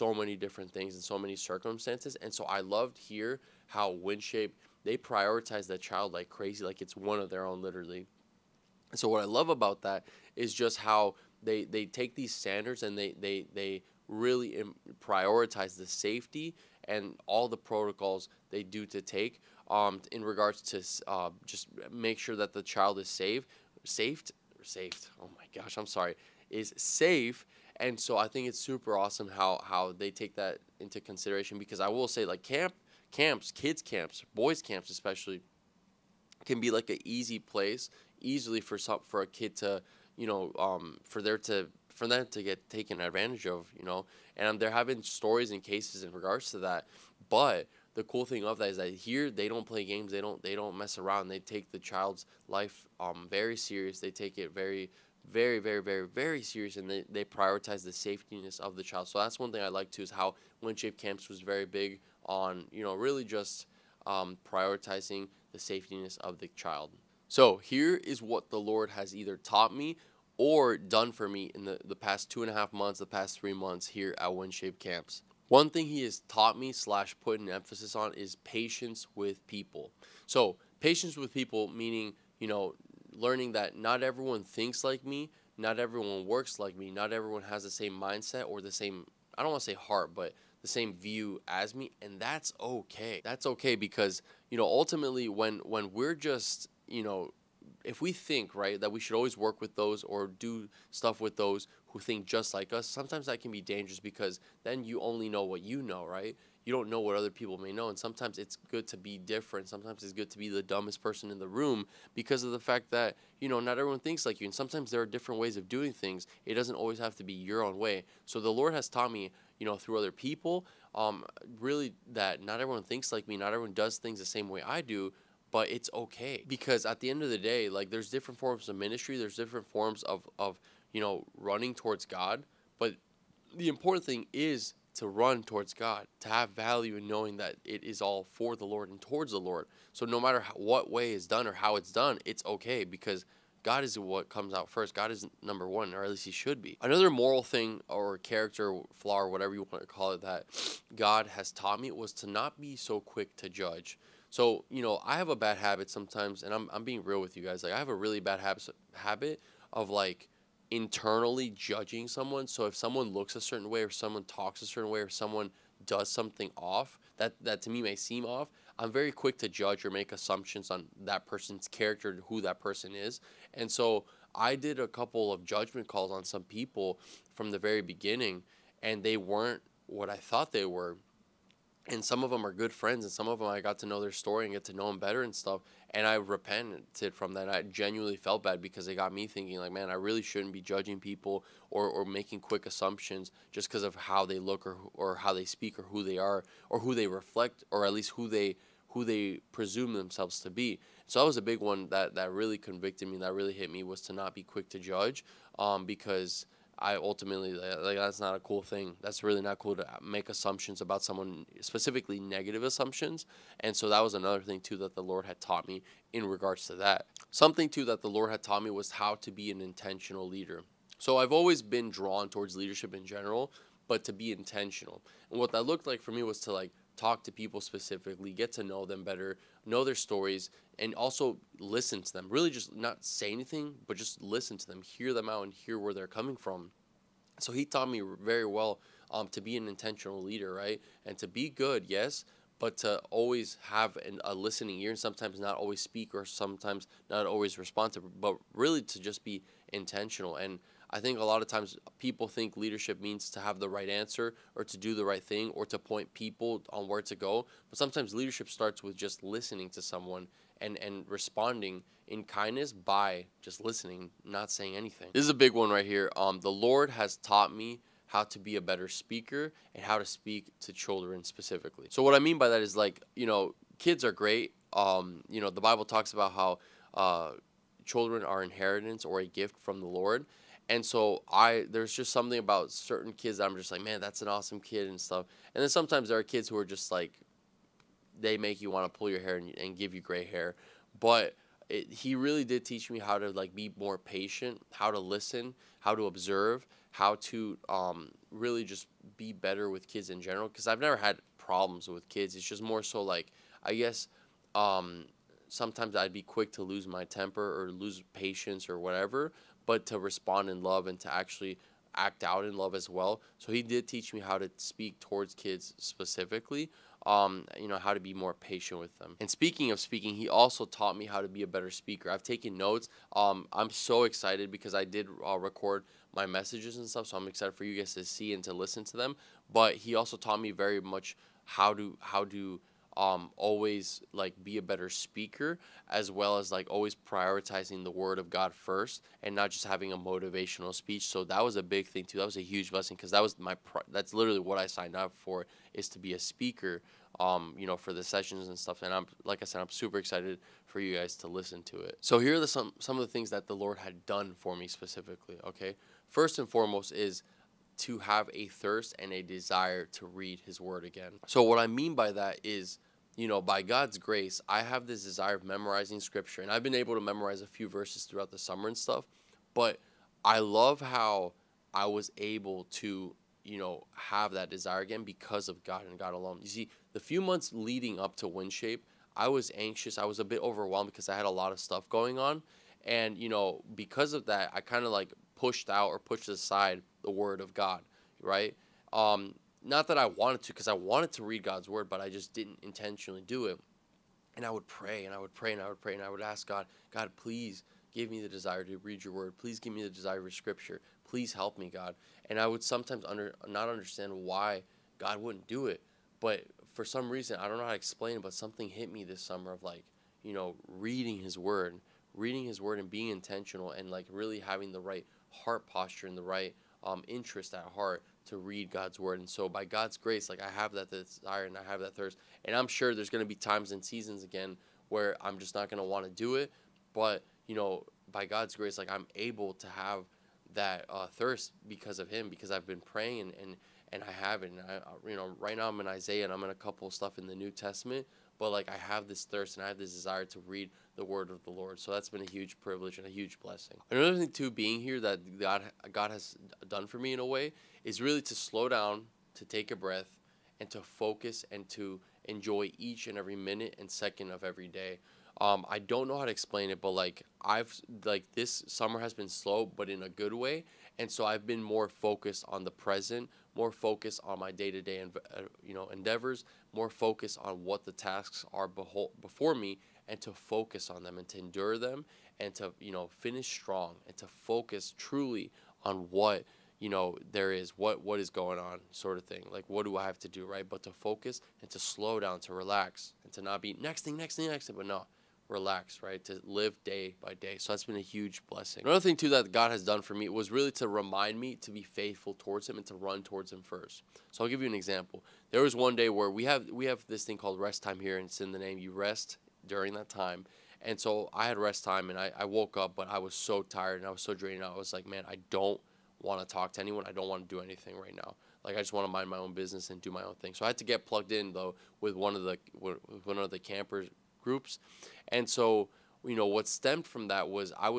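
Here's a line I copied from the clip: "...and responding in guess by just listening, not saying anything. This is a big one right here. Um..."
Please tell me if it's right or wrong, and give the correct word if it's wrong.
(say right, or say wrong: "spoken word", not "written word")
wrong: "kindness", not "guess".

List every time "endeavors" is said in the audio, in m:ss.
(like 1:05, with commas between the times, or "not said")
7:45.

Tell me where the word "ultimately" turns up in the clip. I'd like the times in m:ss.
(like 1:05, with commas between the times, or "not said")
1:34, 3:26.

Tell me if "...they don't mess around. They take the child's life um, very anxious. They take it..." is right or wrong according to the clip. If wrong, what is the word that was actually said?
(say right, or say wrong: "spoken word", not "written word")
wrong: "serious", not "anxious".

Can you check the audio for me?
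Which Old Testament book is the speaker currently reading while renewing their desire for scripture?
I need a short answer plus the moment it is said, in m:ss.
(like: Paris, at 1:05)
Isaiah, at 7:15.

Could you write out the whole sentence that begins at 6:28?
Um, not that I wanted to, because I wanted to read God's word, but I just didn't intentionally do it.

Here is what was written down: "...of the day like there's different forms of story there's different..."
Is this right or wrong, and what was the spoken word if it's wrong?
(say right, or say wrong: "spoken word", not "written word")
wrong: "ministry", not "story".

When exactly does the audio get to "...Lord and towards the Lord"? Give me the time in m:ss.
2:18.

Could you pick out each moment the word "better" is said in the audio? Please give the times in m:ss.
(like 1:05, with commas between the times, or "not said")
3:04, 3:49, 4:28, 4:59, 5:21, 5:34.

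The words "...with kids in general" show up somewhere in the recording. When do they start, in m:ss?
4:59.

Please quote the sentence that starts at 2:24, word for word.
God is number one, or at least He should be.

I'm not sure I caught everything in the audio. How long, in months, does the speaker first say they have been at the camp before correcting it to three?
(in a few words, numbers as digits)
2.5 months.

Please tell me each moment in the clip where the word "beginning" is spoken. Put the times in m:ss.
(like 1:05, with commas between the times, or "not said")
2:57.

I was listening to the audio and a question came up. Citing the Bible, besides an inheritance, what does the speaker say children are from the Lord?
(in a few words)
A gift.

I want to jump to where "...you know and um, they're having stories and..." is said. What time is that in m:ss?
0:43.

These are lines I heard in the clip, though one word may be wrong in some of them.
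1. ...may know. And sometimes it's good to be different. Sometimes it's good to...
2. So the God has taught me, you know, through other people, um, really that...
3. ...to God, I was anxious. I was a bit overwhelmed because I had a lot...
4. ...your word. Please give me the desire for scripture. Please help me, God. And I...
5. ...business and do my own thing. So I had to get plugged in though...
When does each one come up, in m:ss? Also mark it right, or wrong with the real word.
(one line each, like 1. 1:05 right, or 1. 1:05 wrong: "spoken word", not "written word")
1. 1:47 right
2. 1:58 wrong: "Lord", not "God"
3. 6:18 wrong: "Winshape", not "God"
4. 6:39 right
5. 8:29 right.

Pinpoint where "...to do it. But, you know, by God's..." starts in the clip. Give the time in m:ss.
7:06.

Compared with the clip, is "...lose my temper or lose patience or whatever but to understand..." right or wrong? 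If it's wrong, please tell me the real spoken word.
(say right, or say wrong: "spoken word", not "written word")
wrong: "respond", not "understand".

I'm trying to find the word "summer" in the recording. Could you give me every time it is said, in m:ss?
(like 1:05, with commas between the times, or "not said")
6:08, 6:49, 7:38.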